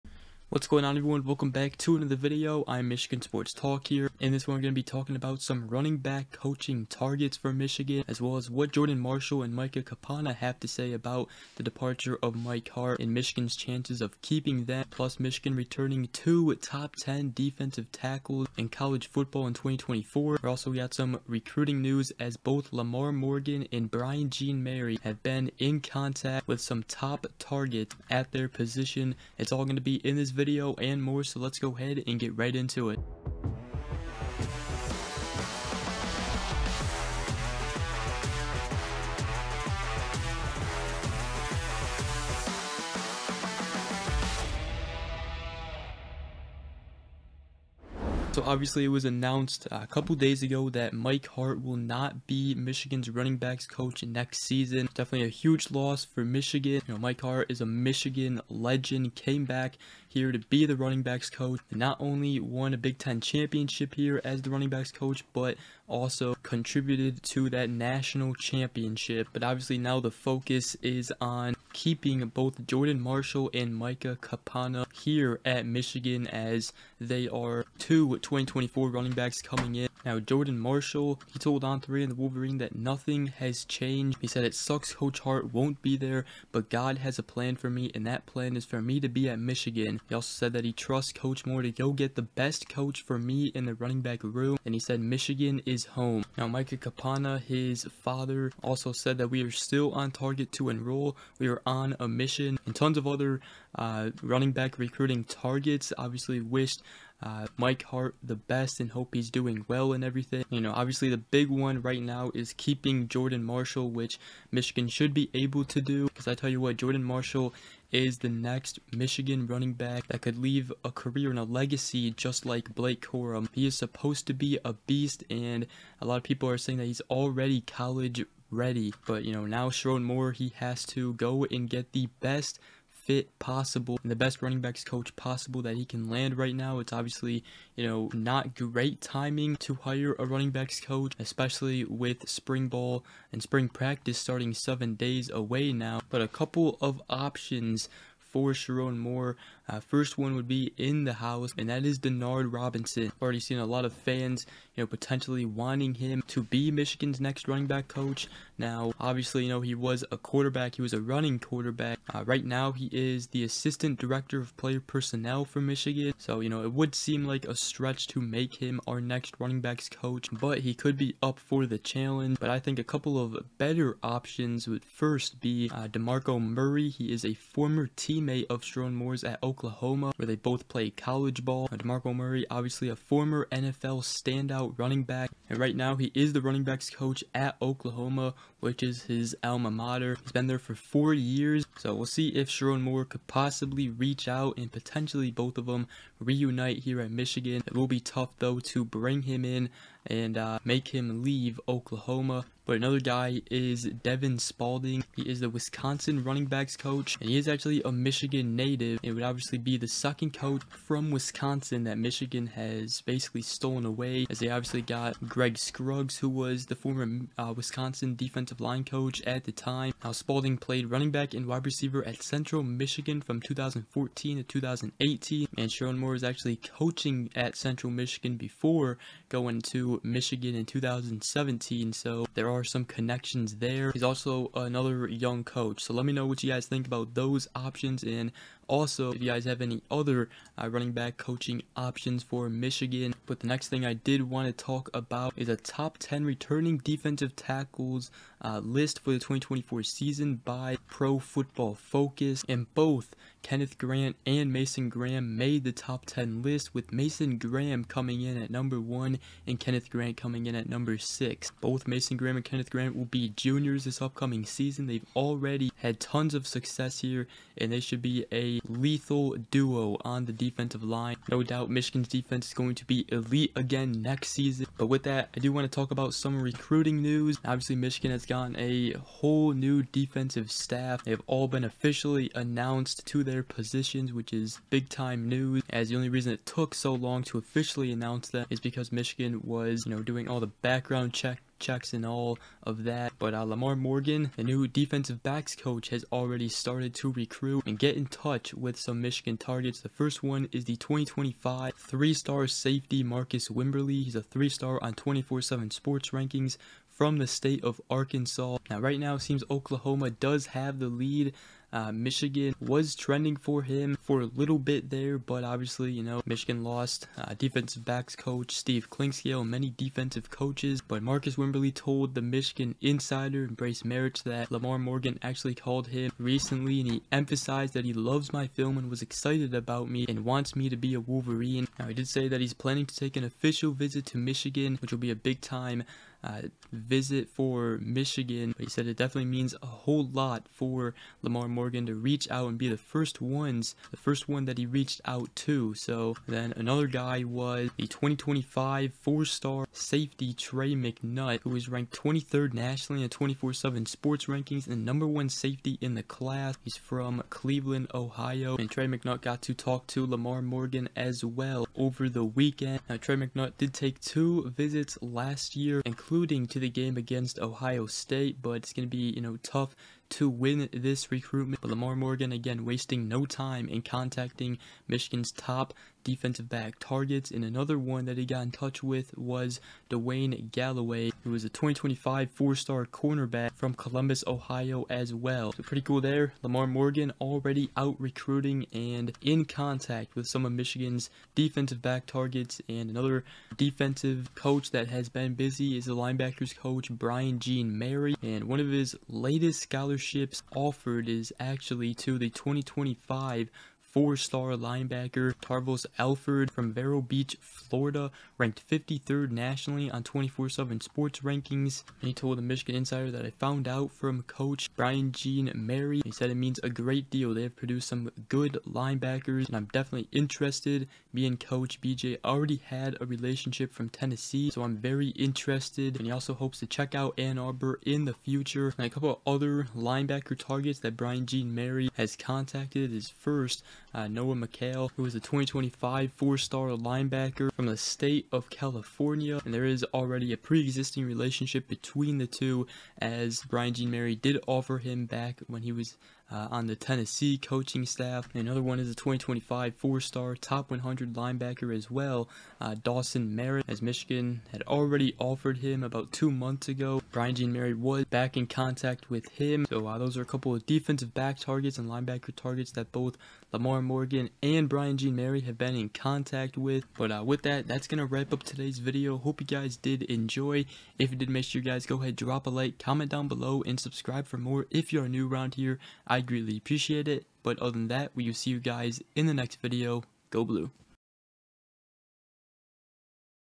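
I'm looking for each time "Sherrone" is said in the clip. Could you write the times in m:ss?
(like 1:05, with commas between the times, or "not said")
2:09, 2:28, 2:58, 3:12, 3:45.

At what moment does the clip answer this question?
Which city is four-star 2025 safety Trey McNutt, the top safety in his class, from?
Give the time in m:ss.
5:57.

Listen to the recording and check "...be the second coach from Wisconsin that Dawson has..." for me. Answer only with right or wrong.
wrong.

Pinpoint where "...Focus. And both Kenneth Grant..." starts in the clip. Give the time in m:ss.
4:11.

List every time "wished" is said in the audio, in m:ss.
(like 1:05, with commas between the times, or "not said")
1:46.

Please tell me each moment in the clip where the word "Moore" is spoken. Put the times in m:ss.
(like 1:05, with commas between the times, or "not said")
1:31, 2:10, 2:28, 2:58, 3:12, 3:45.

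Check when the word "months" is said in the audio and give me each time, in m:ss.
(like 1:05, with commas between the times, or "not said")
7:36.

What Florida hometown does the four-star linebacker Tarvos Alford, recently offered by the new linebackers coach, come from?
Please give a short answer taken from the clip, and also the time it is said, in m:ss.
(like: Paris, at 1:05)
Vero Beach, at 6:46.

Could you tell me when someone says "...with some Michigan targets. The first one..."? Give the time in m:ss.
4:58.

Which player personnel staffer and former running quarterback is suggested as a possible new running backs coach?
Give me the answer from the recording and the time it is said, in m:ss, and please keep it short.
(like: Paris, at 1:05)
Denard Robinson, at 2:31.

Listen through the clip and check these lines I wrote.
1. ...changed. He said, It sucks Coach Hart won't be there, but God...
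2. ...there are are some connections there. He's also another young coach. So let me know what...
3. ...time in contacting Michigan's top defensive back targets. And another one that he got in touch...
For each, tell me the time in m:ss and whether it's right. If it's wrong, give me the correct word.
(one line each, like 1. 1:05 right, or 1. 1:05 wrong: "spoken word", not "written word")
1. 1:23 right
2. 3:52 right
3. 6:13 right.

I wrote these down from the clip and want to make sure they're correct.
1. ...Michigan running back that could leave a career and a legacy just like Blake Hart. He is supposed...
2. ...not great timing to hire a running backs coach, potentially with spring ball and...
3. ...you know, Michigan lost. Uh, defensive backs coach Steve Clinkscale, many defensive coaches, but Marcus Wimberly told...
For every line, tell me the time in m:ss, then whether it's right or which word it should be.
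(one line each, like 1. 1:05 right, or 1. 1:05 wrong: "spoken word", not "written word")
1. 1:58 wrong: "Corum", not "Hart"
2. 2:18 wrong: "especially", not "potentially"
3. 5:15 right.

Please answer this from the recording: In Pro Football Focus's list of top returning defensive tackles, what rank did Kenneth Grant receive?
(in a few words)
6.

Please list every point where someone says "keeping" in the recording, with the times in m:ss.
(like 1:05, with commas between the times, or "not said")
0:14, 1:11, 1:52.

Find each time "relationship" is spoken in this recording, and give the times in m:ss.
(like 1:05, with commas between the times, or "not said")
7:03, 7:21.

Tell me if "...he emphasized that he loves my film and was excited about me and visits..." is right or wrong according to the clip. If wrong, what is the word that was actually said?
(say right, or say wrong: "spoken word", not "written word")
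wrong: "wants", not "visits".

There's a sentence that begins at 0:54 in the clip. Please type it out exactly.
Definitely a huge loss for Michigan.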